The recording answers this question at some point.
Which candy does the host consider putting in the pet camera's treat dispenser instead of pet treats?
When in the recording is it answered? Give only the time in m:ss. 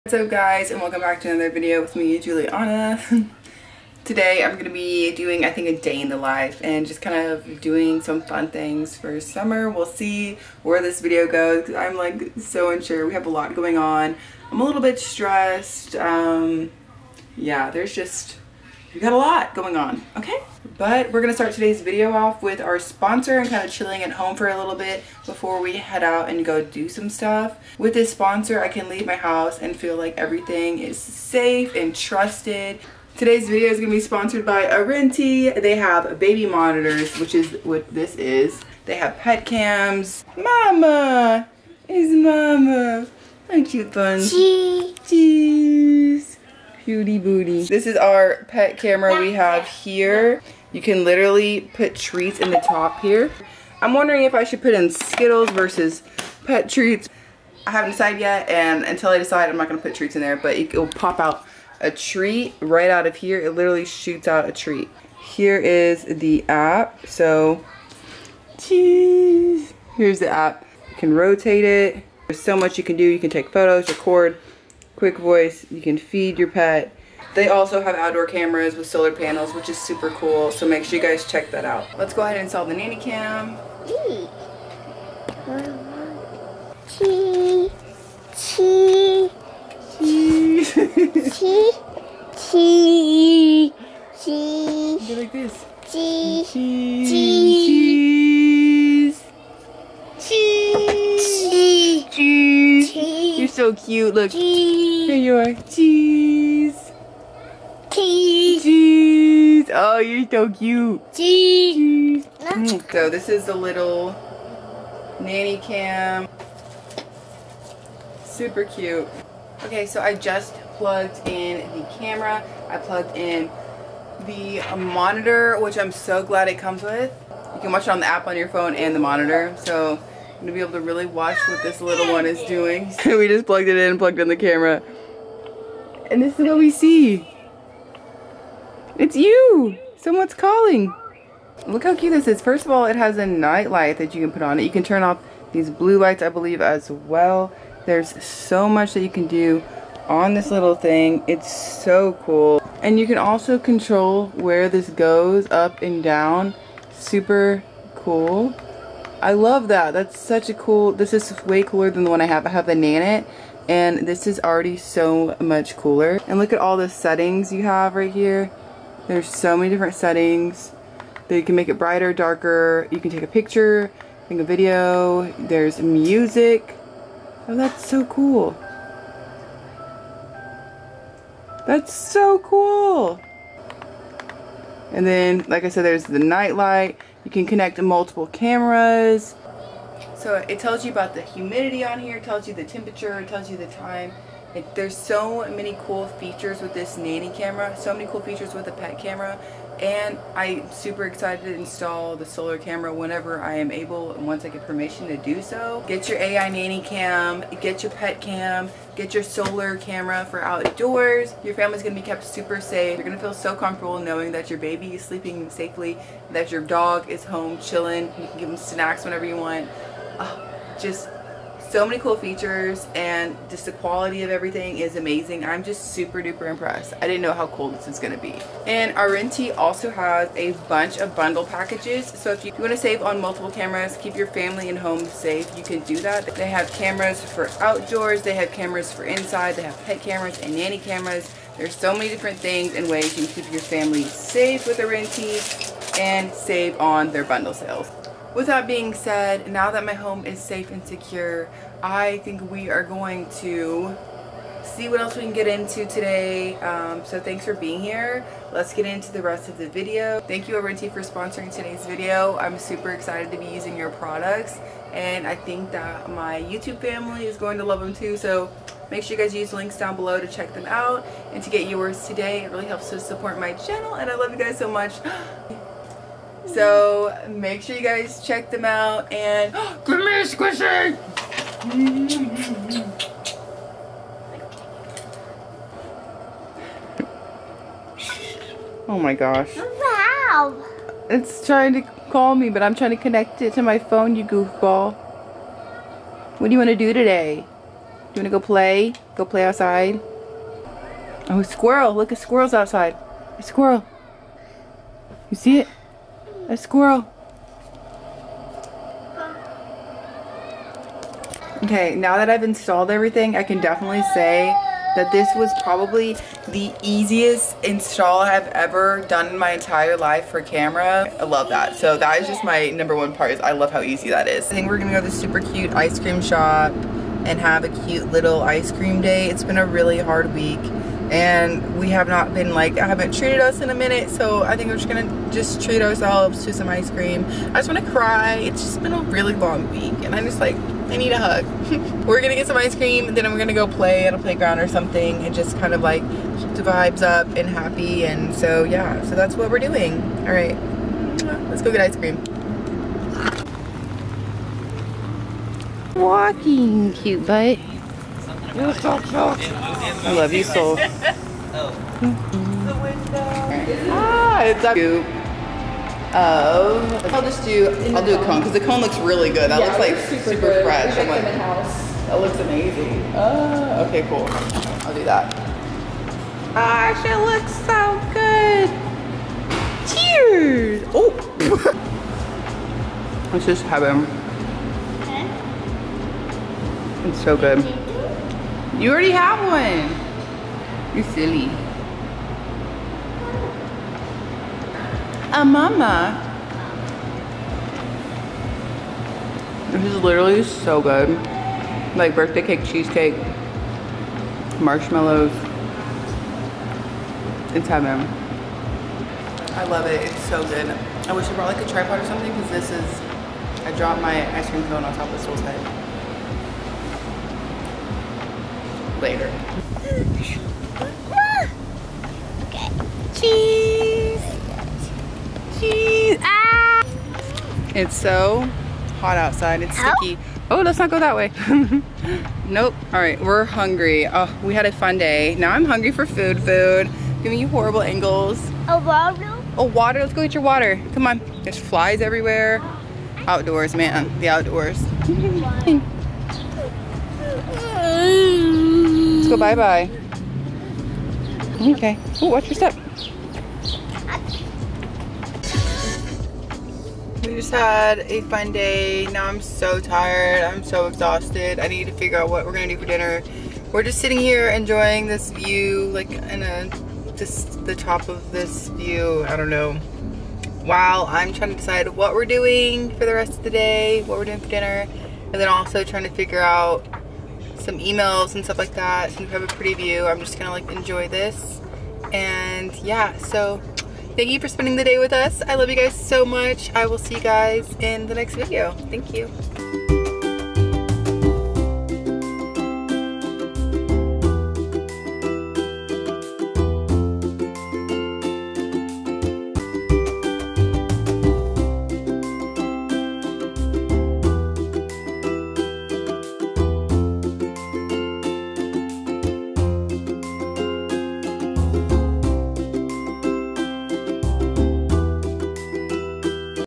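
0:54.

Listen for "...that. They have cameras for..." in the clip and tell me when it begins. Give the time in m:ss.
3:56.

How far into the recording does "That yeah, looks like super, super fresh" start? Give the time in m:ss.
6:09.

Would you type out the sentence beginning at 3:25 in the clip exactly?
Get your AI nanny cam, get your pet cam, get your solar camera for outdoors.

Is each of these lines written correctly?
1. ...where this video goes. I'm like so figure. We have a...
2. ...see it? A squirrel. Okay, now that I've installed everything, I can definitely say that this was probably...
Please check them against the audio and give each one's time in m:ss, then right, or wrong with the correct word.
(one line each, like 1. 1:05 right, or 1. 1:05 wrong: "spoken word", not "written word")
1. 0:10 wrong: "unsure", not "figure"
2. 5:05 right.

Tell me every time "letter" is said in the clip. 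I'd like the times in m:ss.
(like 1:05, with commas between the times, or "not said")
not said.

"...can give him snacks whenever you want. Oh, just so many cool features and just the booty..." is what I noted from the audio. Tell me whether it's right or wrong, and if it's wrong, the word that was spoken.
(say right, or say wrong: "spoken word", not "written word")
wrong: "quality", not "booty".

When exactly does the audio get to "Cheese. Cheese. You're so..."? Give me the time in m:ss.
1:42.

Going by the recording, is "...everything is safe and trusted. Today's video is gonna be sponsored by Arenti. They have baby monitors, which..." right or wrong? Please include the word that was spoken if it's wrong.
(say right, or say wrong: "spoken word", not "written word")
right.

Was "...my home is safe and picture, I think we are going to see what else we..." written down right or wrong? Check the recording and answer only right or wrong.
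wrong.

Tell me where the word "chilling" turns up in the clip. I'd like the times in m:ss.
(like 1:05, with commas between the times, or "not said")
0:23, 3:37.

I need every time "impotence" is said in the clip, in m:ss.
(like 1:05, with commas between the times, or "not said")
not said.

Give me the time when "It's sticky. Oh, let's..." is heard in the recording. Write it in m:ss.
7:09.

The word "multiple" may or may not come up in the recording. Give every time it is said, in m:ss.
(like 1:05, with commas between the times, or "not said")
3:07, 3:53.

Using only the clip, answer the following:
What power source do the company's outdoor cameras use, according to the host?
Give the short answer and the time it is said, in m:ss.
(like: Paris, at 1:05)
Solar panels, at 1:18.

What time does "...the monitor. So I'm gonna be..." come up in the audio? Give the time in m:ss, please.
2:08.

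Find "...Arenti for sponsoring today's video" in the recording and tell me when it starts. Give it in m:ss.
4:20.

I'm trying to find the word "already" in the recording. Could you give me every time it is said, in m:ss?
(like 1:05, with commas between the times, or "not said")
2:44, 6:28.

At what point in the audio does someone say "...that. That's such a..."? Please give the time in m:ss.
2:39.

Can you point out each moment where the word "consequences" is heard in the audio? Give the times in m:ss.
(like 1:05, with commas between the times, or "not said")
not said.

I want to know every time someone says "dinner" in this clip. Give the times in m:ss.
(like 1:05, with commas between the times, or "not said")
7:42, 7:54.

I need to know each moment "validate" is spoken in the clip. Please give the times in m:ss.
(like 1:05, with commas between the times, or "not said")
not said.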